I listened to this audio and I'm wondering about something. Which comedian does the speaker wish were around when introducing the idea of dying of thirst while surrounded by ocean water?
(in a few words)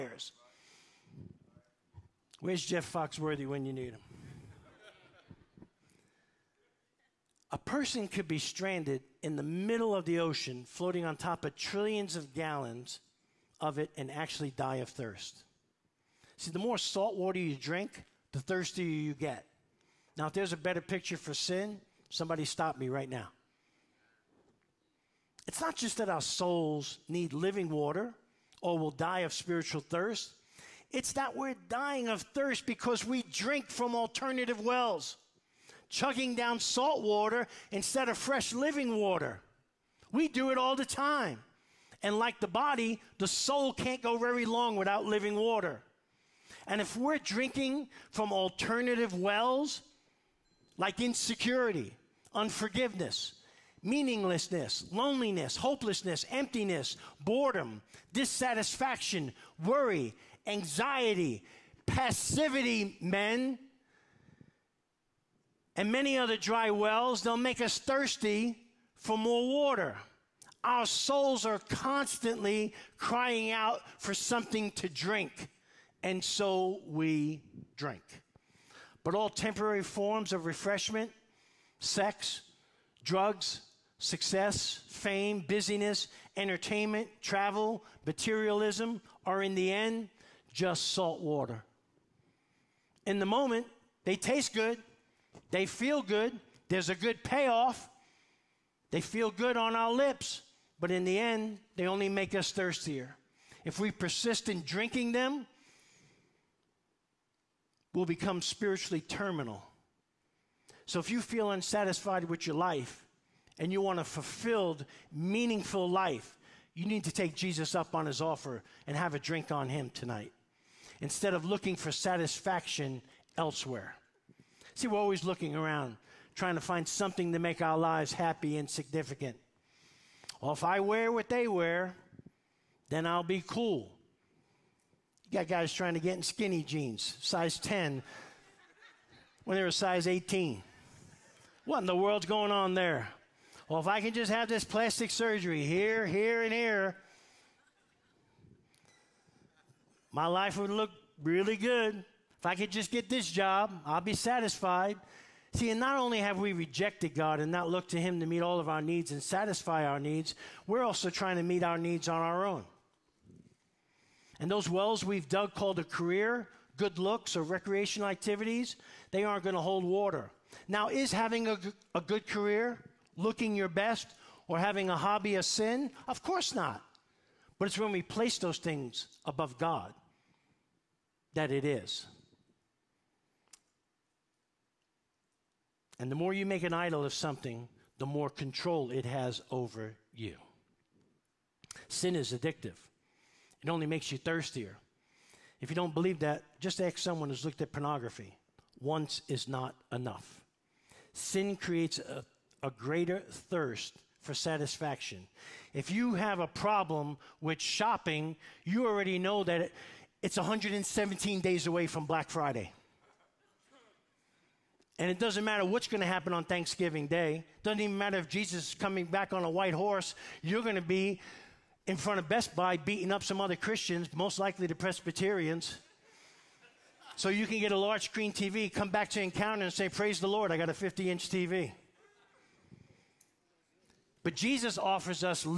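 Jeff Foxworthy.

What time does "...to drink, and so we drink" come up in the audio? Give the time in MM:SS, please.
01:14.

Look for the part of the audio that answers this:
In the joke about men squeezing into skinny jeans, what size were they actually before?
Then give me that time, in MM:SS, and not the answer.
02:19.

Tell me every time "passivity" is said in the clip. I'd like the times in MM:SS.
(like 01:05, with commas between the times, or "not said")
01:01.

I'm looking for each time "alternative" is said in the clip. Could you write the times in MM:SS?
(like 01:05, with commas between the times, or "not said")
00:33, 00:48.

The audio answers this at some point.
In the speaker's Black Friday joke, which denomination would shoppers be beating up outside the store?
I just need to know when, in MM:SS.
03:44.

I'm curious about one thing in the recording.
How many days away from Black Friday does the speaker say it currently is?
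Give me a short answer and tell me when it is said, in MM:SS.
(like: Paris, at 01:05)
117, at 03:30.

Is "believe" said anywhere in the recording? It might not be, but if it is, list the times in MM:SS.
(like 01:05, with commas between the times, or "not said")
03:15.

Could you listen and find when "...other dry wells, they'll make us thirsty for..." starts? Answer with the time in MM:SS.
01:06.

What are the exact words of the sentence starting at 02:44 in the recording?
And those wells we've dug called a career, good looks, or recreational activities, they aren't going to hold water.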